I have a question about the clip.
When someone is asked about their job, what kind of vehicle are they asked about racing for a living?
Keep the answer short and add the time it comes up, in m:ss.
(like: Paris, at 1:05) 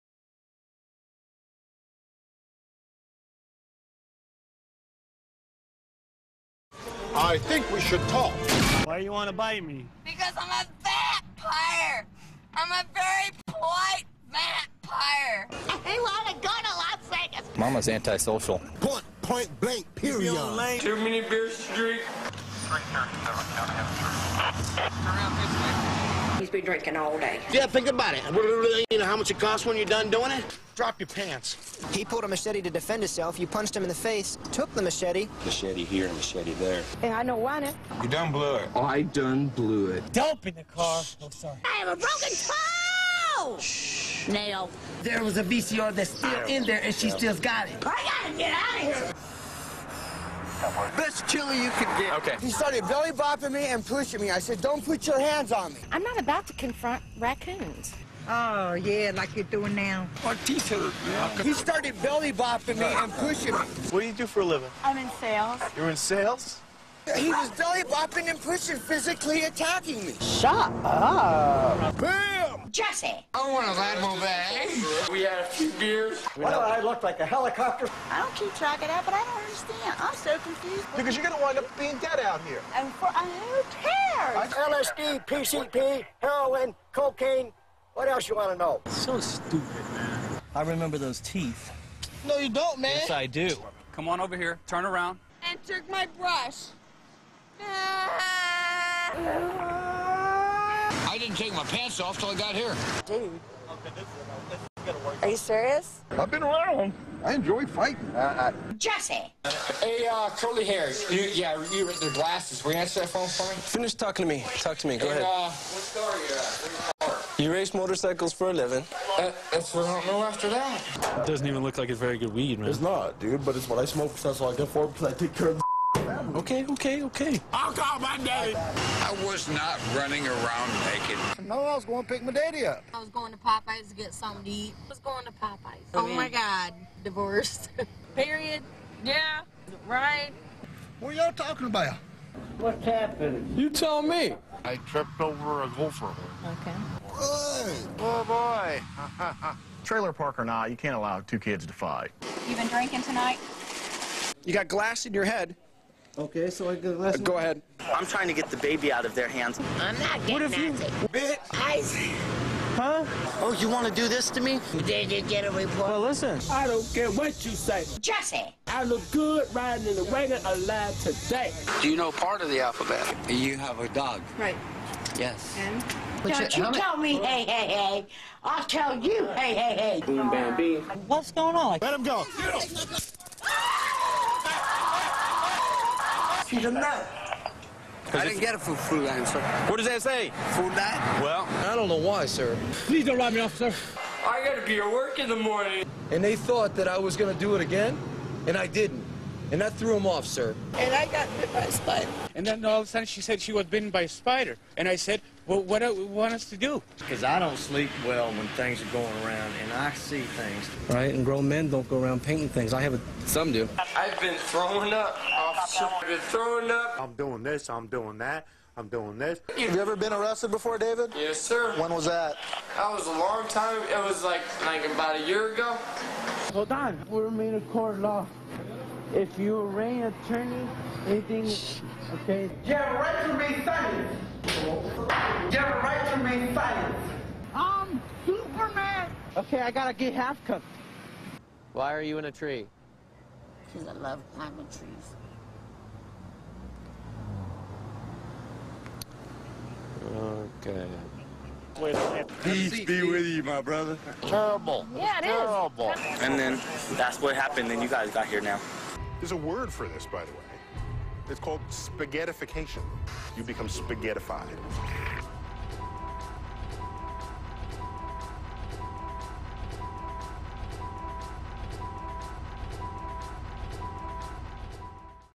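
Motorcycles, at 1:57.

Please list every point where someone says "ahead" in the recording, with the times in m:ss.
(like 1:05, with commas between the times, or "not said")
1:55, 2:37.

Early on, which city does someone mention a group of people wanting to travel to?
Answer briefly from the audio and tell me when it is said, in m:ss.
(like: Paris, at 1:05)
Las Vegas, at 0:16.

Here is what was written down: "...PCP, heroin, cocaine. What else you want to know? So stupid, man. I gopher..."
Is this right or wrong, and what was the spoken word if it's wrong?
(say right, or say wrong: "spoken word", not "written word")
wrong: "remember", not "gopher".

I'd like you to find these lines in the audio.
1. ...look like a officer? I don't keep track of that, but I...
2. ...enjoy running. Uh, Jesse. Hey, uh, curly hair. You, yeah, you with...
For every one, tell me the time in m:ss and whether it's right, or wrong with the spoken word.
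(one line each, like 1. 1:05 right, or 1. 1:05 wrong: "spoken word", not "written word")
1. 1:16 wrong: "helicopter", not "officer"
2. 1:47 wrong: "fighting", not "running".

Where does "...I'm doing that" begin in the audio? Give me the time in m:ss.
3:37.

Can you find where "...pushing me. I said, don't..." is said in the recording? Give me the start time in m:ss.
0:53.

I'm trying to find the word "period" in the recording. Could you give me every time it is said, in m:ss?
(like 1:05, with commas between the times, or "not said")
0:19, 2:18.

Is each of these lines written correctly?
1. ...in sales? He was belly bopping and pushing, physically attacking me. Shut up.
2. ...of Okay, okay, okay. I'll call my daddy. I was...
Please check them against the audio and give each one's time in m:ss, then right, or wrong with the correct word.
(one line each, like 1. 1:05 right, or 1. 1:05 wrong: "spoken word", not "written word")
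1. 1:05 right
2. 2:05 right.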